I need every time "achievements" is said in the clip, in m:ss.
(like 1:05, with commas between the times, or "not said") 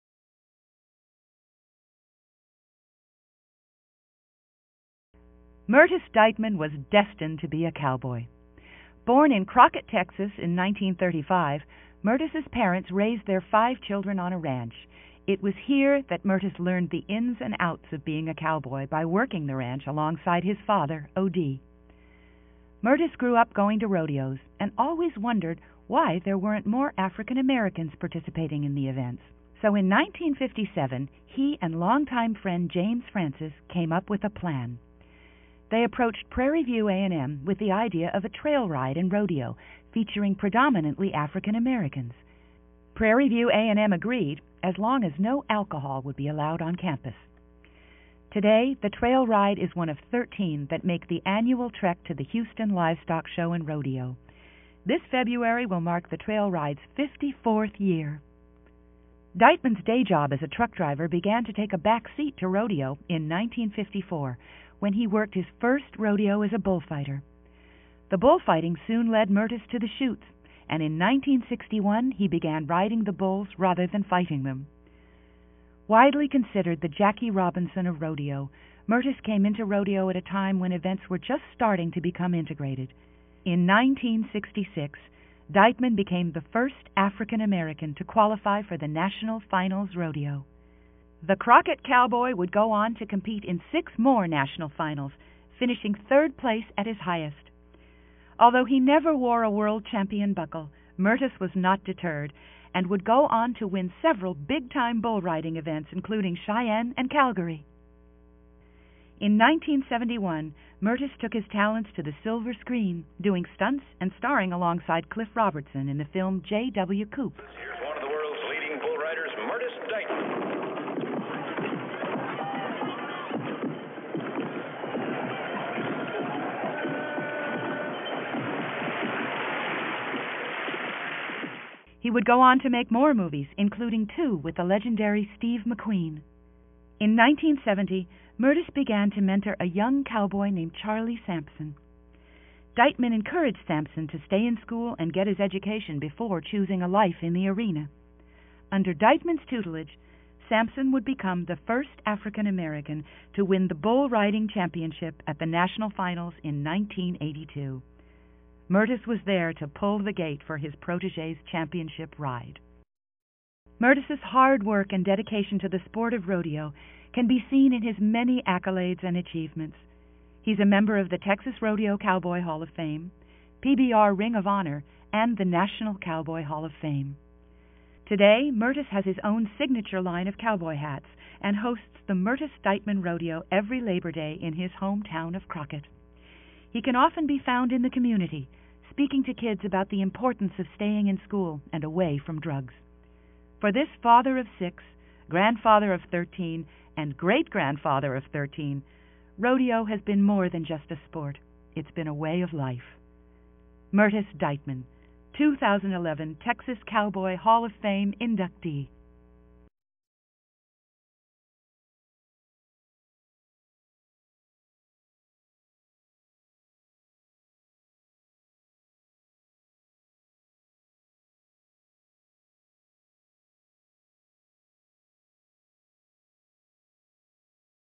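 2:49.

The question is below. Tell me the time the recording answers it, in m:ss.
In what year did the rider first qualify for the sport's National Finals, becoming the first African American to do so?
1:23.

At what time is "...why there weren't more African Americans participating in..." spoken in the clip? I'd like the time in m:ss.
0:25.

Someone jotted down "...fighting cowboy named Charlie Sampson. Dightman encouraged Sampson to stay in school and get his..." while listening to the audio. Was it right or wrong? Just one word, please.
wrong.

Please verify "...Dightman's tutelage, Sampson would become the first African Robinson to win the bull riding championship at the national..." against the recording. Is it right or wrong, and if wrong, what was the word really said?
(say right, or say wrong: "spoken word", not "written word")
wrong: "American", not "Robinson".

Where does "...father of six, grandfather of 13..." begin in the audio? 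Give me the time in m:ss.
3:14.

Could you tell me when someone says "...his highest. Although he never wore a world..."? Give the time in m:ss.
1:36.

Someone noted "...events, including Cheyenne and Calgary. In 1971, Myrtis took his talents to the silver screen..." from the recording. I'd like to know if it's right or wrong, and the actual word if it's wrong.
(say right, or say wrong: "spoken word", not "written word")
right.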